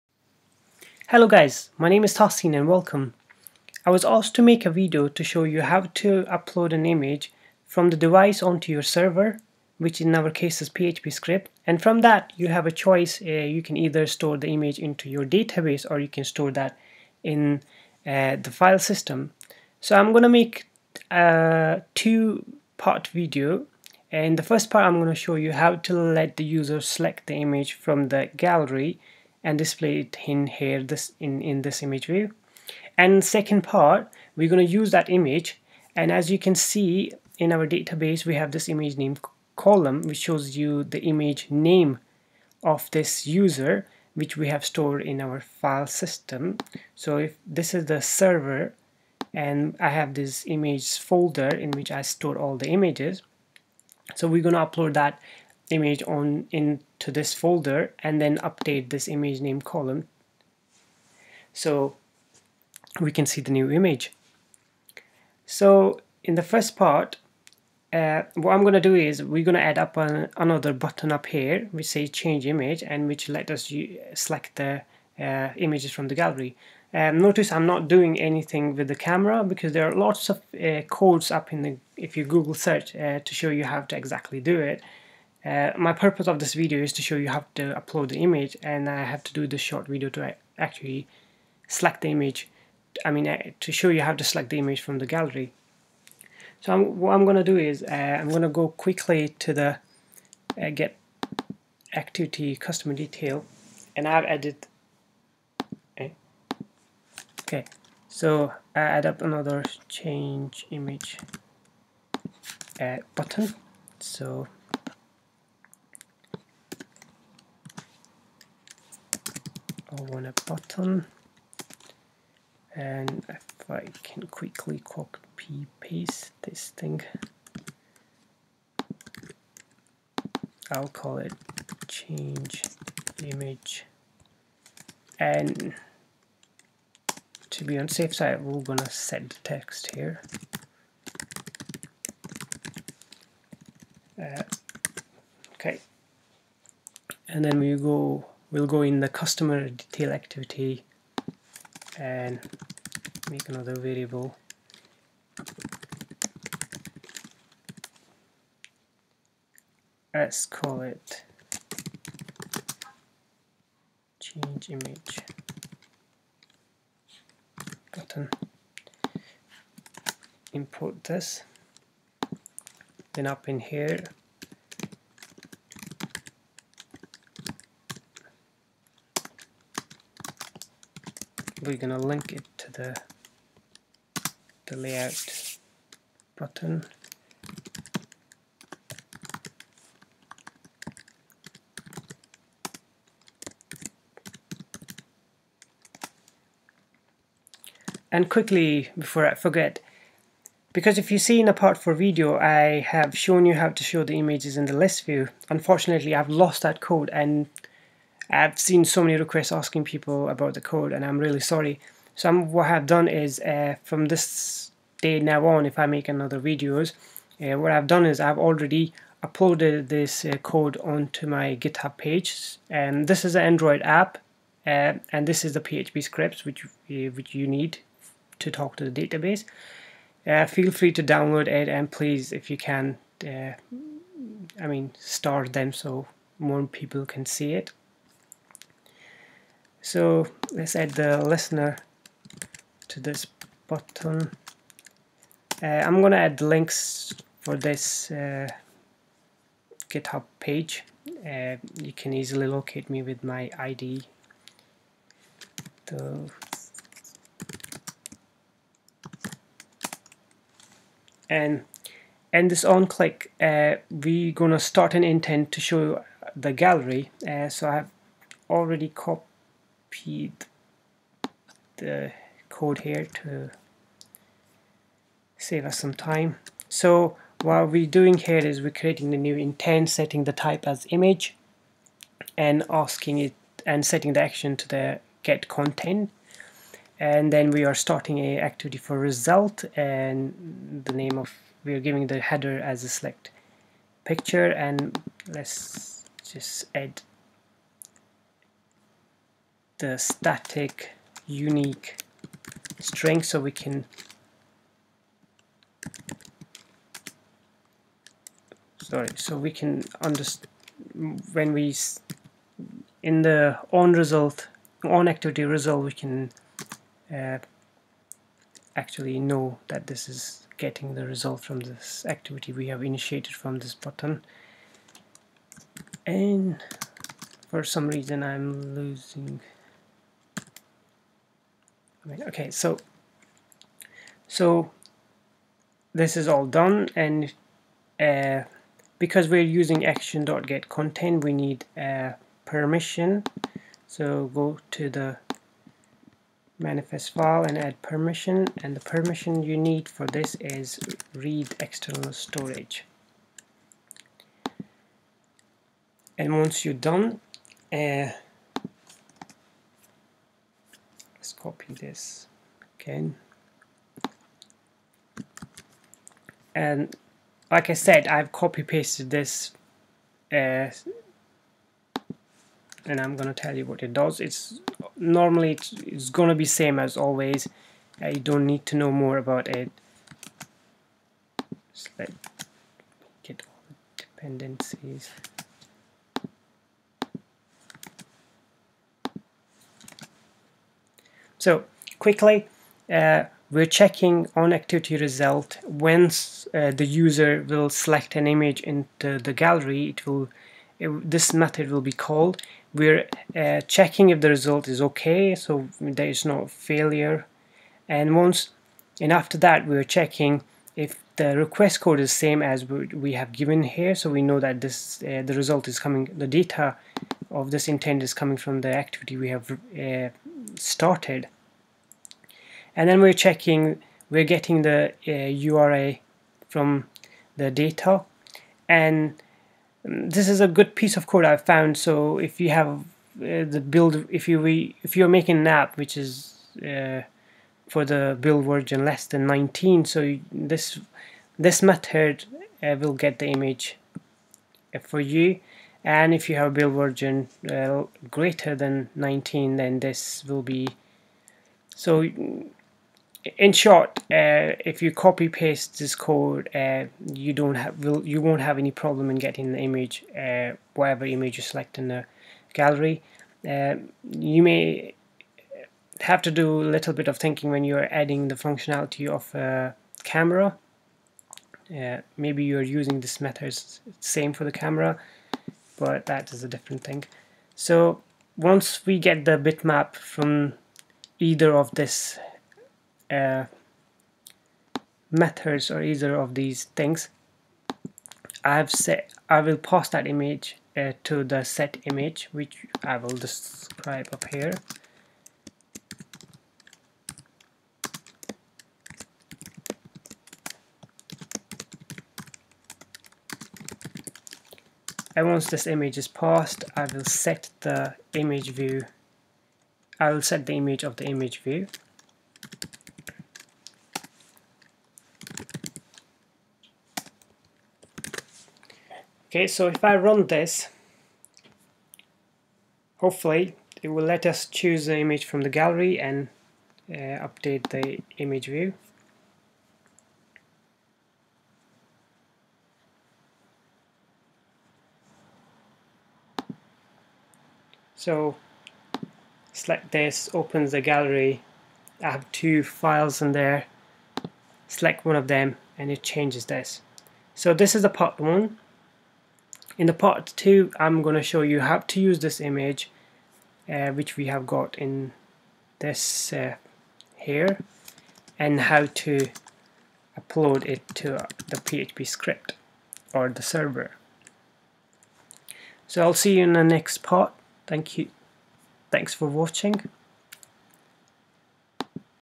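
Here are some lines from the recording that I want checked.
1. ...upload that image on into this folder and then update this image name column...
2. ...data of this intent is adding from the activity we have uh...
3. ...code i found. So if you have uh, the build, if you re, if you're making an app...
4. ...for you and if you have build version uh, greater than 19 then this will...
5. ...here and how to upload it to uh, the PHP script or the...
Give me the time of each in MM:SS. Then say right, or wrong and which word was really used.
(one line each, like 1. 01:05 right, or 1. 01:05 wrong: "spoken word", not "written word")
1. 00:54 right
2. 06:56 wrong: "coming", not "adding"
3. 07:11 right
4. 07:24 right
5. 09:17 right.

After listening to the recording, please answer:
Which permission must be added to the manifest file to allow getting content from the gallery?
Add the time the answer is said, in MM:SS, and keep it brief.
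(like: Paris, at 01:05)
read external storage, at 05:51.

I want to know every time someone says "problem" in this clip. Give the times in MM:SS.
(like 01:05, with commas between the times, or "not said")
07:38.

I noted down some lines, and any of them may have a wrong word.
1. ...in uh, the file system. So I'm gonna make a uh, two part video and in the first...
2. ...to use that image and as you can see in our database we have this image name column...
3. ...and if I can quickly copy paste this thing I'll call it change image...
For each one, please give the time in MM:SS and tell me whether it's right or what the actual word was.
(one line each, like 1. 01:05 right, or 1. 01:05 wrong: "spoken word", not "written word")
1. 00:17 right
2. 00:34 right
3. 02:02 right.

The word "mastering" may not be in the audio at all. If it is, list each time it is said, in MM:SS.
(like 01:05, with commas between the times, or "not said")
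not said.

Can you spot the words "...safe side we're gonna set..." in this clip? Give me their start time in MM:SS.
02:17.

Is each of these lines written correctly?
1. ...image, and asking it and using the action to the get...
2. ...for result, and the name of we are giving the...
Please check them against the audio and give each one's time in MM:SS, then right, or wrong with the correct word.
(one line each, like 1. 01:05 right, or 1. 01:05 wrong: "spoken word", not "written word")
1. 04:40 wrong: "setting", not "using"
2. 04:48 right.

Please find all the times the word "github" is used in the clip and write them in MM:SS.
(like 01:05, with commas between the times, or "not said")
03:41, 04:09.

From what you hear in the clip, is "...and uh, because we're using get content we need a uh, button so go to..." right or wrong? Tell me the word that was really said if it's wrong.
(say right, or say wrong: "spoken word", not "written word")
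wrong: "permission", not "button".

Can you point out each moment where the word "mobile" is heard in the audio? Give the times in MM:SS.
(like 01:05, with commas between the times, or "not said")
not said.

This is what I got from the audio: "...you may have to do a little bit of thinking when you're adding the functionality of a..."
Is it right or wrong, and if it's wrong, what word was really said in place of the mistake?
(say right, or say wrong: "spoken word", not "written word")
right.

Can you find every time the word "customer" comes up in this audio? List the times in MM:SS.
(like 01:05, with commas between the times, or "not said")
01:42, 02:29.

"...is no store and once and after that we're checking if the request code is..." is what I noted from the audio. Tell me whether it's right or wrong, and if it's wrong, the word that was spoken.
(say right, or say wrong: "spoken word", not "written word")
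wrong: "failure", not "store".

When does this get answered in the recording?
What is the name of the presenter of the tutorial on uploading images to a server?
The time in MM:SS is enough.
00:02.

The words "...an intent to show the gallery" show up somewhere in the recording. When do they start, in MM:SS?
04:24.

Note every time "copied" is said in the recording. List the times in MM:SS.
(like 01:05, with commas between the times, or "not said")
04:28.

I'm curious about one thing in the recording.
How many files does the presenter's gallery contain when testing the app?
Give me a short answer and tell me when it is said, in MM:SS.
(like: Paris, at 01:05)
2, at 09:02.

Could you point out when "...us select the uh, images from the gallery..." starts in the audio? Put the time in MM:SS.
01:13.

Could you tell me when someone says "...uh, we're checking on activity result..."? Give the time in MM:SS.
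06:32.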